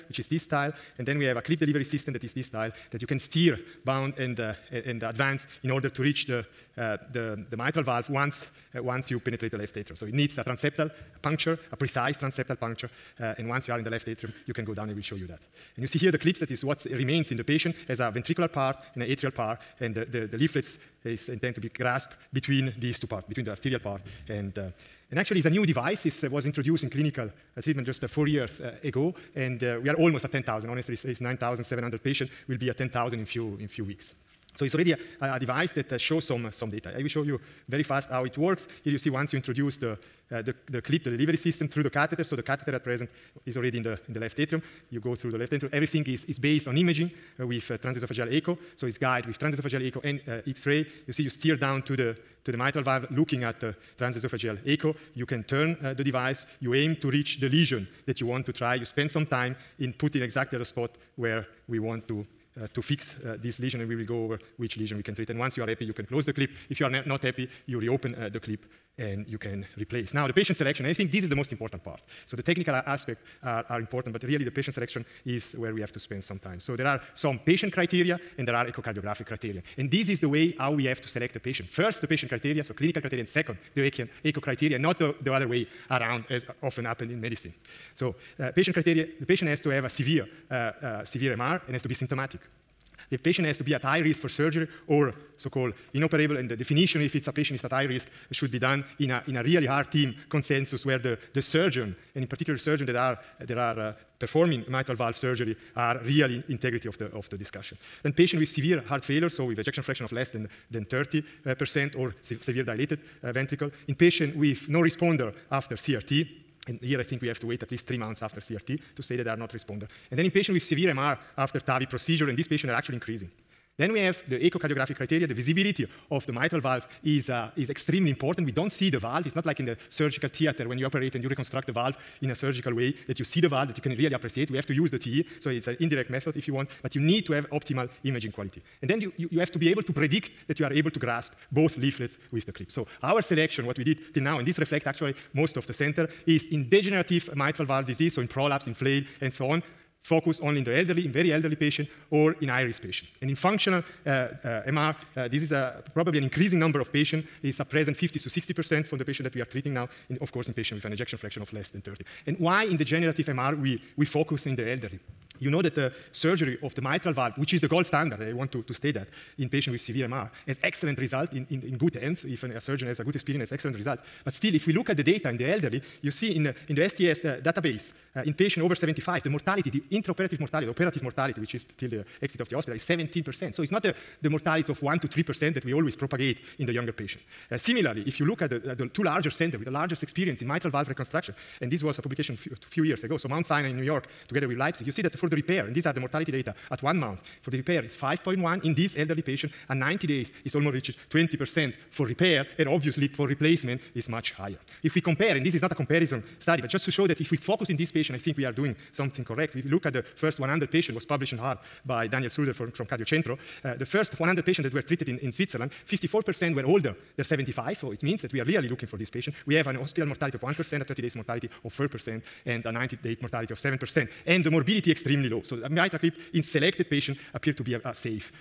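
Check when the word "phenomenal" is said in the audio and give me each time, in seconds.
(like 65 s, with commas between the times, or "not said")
not said.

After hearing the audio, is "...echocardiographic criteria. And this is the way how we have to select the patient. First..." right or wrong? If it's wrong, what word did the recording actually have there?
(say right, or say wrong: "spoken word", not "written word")
right.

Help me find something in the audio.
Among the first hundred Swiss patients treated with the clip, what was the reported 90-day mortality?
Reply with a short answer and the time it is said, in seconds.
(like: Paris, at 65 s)
7%, at 223 s.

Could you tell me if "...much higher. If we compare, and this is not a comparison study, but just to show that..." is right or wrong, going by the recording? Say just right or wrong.
right.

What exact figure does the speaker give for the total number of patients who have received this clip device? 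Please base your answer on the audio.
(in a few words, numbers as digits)
9,700.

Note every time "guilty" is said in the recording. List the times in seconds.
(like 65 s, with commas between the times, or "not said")
not said.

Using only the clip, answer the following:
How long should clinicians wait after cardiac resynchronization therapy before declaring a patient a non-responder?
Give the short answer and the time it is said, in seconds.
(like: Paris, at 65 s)
3 months, at 117 s.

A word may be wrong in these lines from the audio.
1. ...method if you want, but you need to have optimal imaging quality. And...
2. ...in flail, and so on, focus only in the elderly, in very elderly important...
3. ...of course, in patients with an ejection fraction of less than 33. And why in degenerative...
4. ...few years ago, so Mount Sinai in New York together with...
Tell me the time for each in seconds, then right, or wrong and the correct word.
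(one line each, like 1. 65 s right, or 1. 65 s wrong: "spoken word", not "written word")
1. 136 s right
2. 148 s wrong: "patient", not "important"
3. 160 s wrong: "30", not "33"
4. 192 s right.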